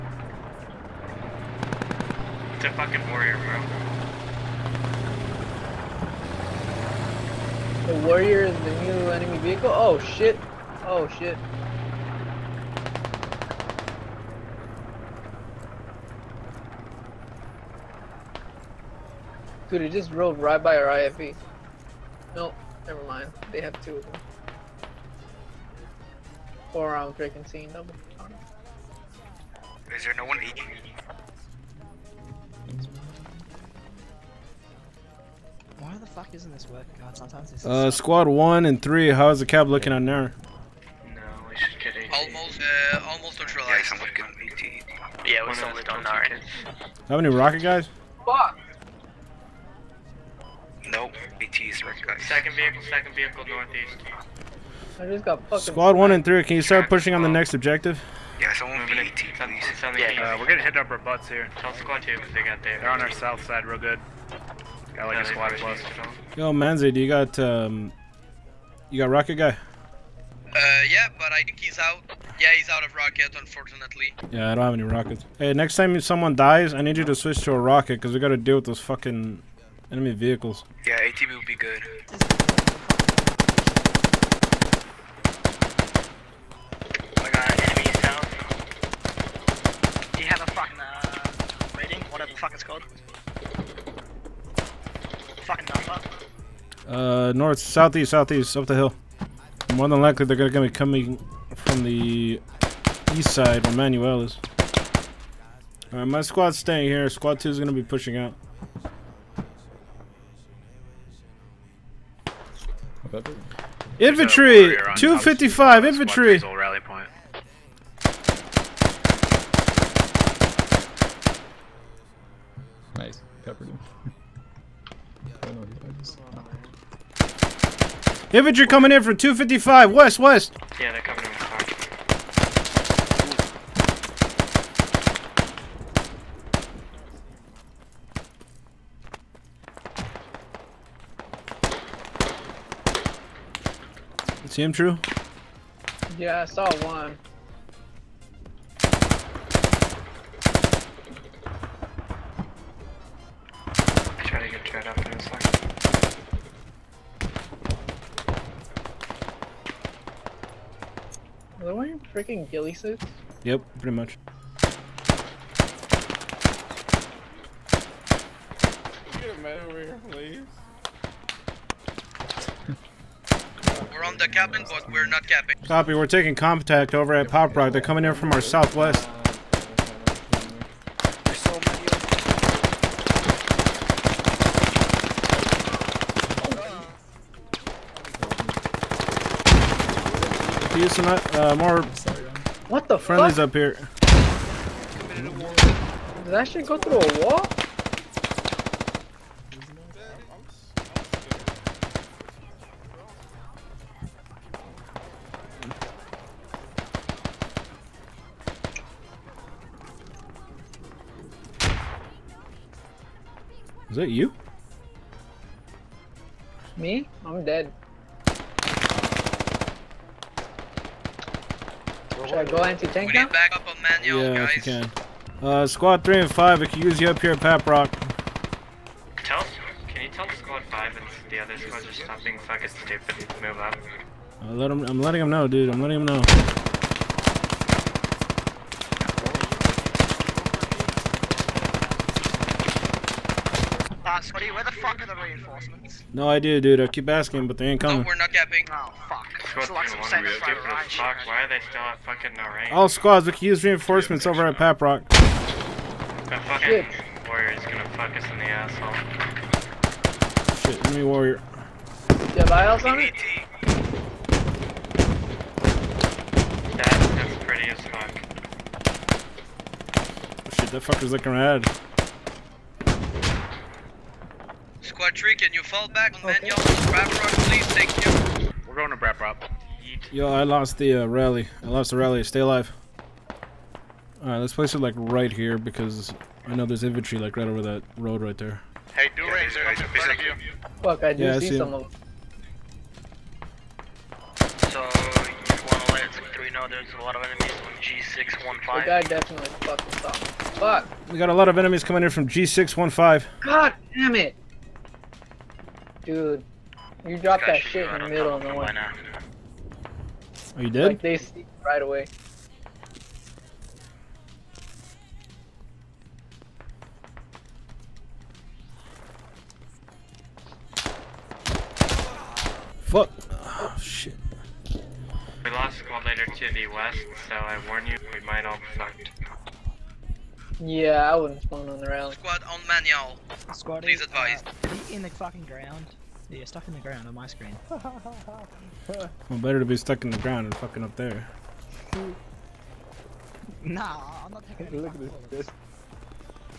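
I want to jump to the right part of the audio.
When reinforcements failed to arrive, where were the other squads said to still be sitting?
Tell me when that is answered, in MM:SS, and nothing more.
04:12.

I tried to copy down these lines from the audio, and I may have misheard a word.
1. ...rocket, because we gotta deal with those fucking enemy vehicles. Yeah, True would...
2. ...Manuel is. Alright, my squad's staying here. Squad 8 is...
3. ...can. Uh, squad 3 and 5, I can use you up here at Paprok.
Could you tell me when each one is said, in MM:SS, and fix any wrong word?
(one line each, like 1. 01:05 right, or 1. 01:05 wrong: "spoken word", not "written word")
1. 01:17 wrong: "ATV", not "True"
2. 01:43 wrong: "2", not "8"
3. 03:44 right.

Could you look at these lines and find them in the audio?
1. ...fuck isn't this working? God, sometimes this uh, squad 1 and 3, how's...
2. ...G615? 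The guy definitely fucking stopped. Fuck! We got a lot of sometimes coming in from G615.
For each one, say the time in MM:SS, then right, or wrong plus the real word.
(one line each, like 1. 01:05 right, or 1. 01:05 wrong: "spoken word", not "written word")
1. 00:36 right
2. 04:57 wrong: "enemies", not "sometimes".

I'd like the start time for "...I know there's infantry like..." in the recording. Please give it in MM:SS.
04:46.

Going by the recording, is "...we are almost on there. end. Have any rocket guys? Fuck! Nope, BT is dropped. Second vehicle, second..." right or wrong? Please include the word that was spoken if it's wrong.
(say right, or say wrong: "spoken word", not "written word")
wrong: "recognized", not "dropped".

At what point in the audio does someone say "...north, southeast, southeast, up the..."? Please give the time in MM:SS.
01:37.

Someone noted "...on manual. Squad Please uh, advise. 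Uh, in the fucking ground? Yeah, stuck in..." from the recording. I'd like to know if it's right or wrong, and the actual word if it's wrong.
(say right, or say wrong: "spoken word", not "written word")
right.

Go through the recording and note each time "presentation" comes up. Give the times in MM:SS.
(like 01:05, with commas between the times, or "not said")
not said.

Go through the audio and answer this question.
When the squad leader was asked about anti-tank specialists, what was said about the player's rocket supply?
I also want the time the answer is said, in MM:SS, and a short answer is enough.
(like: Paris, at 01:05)
He's out of rocket, at 01:12.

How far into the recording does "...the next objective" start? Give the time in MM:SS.
00:57.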